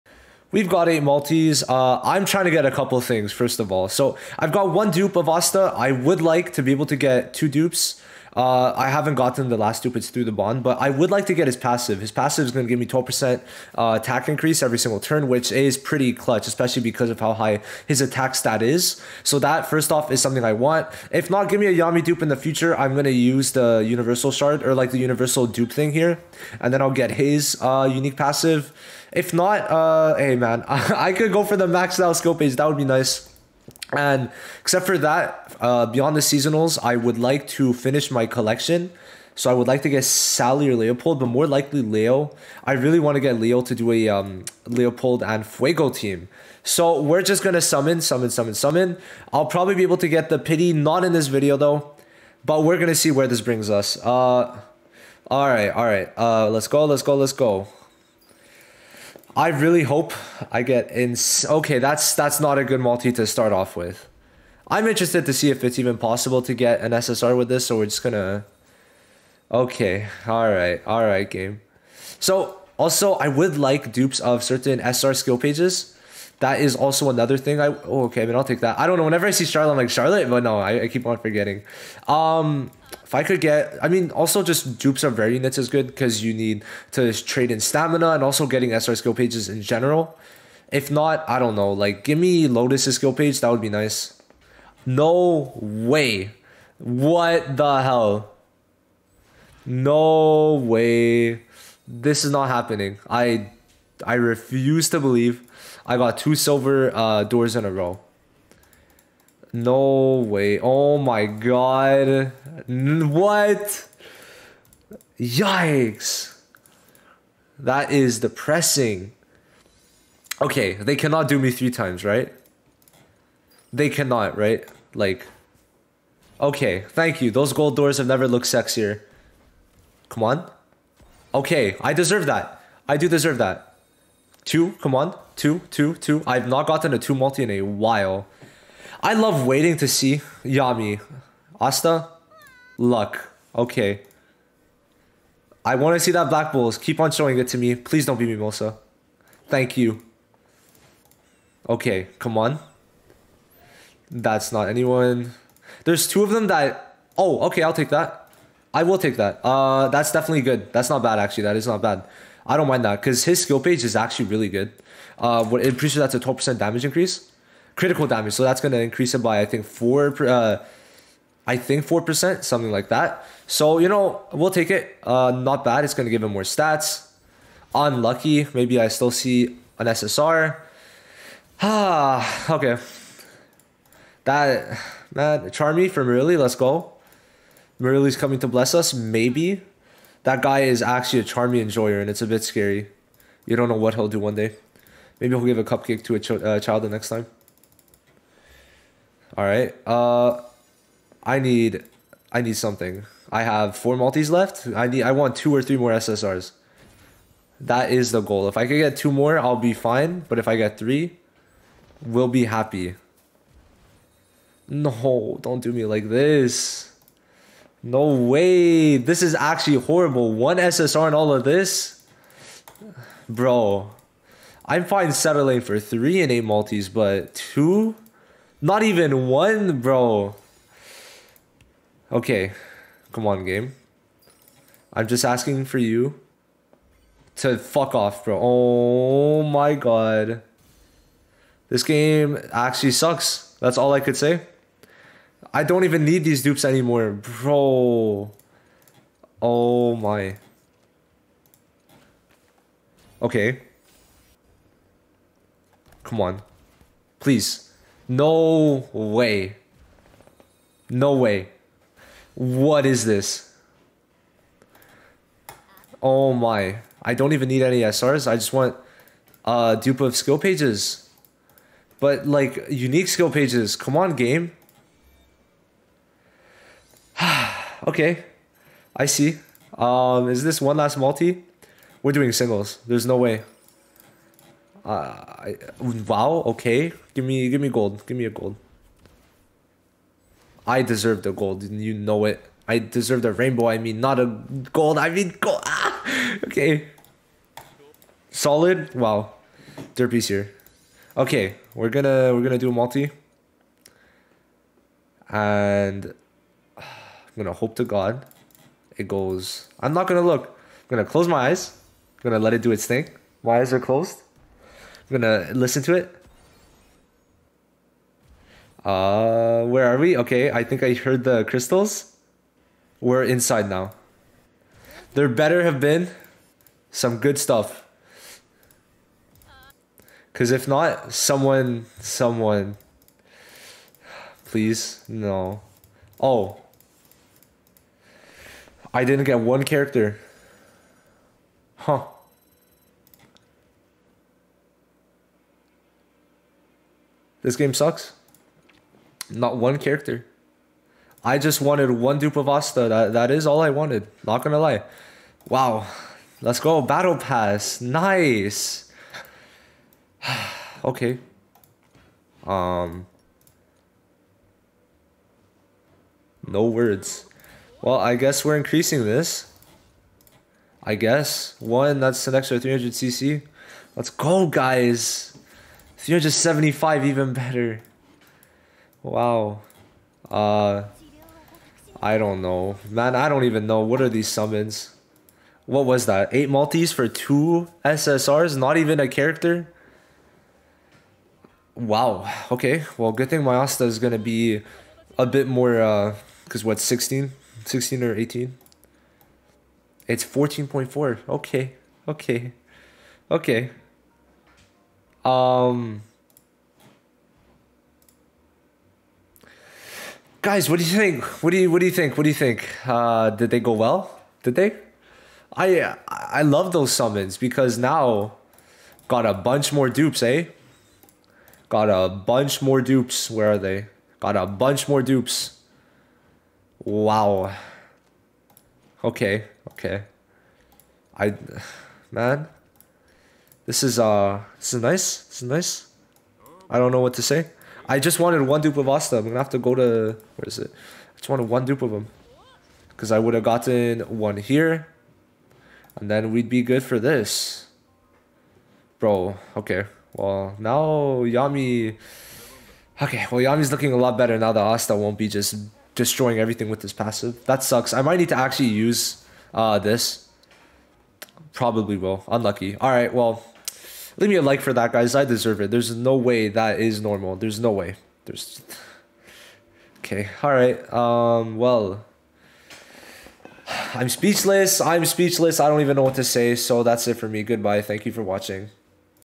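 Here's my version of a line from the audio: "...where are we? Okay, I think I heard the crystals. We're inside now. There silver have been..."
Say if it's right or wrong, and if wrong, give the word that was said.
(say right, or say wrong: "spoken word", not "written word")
wrong: "better", not "silver".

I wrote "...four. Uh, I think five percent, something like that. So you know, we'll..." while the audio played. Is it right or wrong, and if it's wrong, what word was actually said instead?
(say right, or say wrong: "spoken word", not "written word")
wrong: "four", not "five".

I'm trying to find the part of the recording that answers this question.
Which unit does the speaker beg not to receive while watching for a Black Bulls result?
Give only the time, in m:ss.
2:27.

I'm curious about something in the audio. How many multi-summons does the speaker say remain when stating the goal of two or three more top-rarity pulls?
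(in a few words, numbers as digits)
4.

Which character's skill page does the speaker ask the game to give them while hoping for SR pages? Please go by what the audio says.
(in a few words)
Lotus.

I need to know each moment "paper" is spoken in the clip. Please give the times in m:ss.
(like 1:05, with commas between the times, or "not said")
not said.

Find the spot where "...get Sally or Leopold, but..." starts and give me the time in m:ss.
0:39.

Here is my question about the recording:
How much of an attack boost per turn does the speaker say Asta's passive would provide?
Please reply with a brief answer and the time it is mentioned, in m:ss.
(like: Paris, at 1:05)
12%, at 0:12.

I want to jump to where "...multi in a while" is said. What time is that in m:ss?
2:17.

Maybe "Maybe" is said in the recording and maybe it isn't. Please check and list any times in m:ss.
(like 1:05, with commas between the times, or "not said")
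2:58, 3:08, 3:15.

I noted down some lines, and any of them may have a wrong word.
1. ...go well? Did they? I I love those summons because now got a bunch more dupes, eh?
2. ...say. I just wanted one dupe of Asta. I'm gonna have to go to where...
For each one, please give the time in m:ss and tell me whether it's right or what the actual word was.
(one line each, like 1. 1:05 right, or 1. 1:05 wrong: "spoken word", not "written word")
1. 6:53 right
2. 7:17 right.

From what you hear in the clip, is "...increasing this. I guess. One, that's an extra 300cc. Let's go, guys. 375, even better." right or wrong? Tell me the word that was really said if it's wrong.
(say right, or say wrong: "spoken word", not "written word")
right.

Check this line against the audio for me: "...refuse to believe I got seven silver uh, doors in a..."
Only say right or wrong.
wrong.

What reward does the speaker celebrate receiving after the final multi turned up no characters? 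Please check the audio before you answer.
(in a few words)
Battle Pass.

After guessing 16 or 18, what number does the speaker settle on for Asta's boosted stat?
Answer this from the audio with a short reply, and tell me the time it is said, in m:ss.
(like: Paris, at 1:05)
14.4, at 6:40.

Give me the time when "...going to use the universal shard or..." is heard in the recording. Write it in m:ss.
0:22.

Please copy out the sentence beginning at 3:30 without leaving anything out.
But if I get three, we'll be happy.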